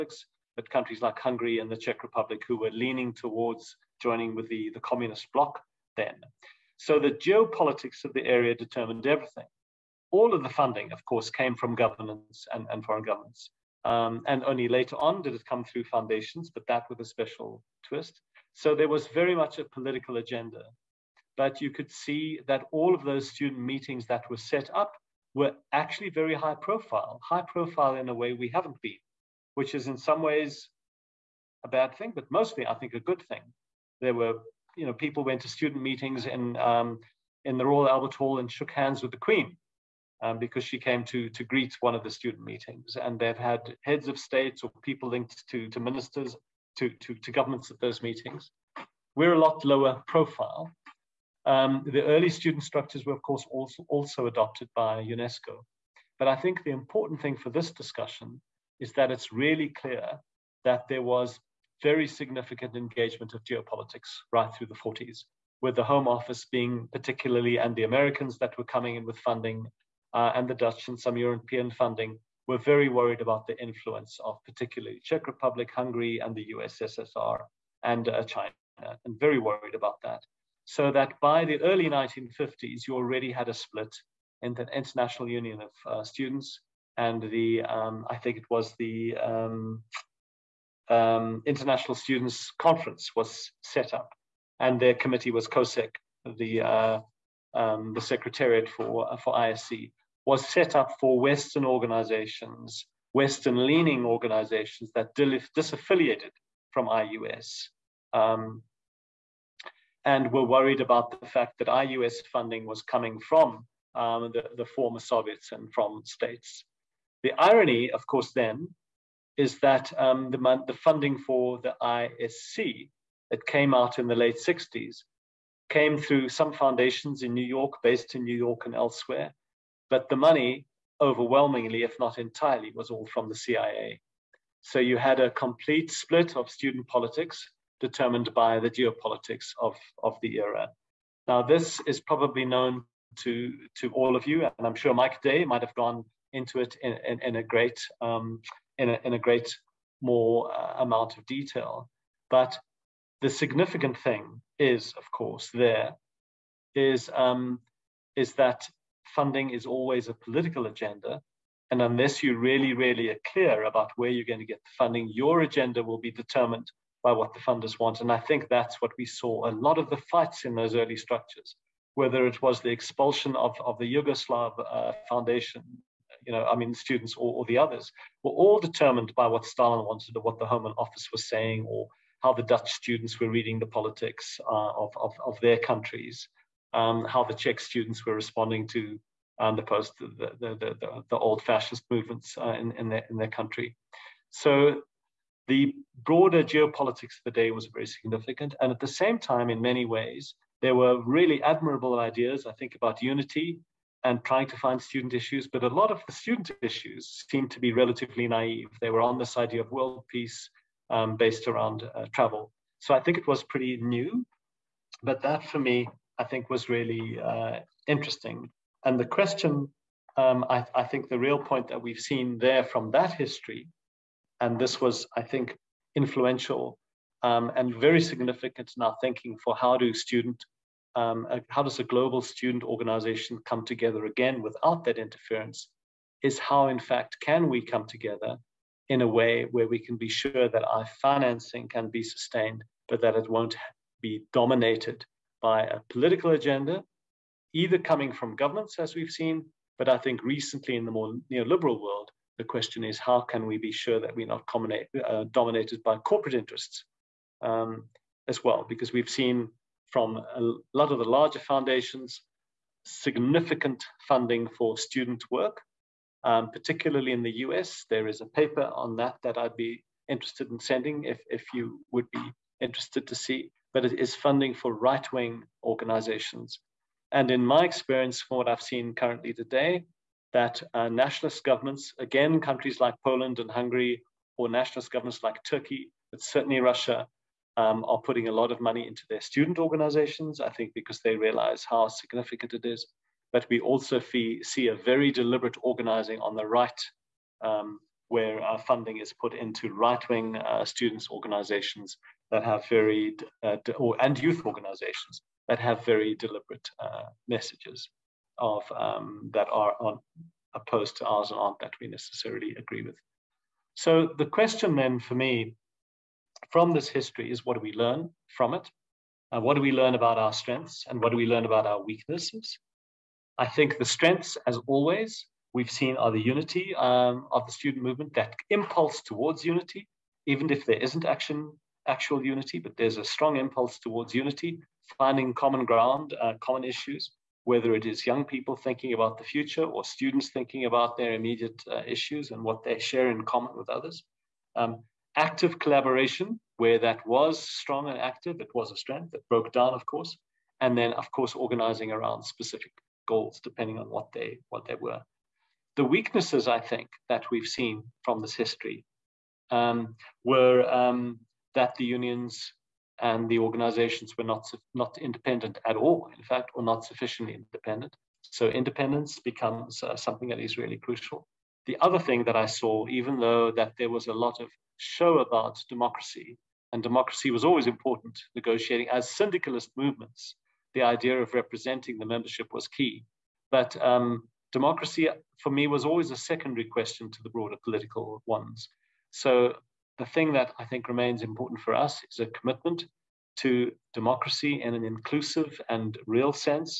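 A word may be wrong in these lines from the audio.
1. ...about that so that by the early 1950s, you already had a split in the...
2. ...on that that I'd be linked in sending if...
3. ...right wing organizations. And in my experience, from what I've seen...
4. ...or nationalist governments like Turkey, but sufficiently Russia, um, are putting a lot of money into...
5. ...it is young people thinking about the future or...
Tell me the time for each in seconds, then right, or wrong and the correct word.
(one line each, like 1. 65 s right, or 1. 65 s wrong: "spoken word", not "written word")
1. 79 s right
2. 268 s wrong: "interested", not "linked"
3. 274 s right
4. 284 s wrong: "certainly", not "sufficiently"
5. 337 s right.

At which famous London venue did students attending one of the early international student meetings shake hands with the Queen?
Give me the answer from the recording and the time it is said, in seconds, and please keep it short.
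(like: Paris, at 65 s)
Royal Albert Hall, at 37 s.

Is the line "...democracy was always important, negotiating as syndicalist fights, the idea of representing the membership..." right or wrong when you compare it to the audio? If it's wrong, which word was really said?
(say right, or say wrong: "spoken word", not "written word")
wrong: "movements", not "fights".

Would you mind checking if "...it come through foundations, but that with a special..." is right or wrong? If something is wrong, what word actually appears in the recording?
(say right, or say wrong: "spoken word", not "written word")
right.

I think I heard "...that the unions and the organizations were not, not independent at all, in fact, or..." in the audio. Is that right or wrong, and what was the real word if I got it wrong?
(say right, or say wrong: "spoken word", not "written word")
right.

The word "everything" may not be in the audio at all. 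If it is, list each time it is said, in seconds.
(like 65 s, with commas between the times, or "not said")
9 s.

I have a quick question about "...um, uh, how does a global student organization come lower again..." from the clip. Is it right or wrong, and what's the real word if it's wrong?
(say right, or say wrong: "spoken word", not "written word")
wrong: "together", not "lower".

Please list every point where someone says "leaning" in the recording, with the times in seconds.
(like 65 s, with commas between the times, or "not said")
2 s, 103 s.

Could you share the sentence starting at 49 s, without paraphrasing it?
We're a lot lower profile, um, the early student structures were, of course, also, also adopted by UNESCO.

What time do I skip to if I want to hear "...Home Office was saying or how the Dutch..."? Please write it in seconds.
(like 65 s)
180 s.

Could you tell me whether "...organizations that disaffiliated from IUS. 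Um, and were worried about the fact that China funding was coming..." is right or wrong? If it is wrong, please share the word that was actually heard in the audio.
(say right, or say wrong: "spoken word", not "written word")
wrong: "IUS", not "China".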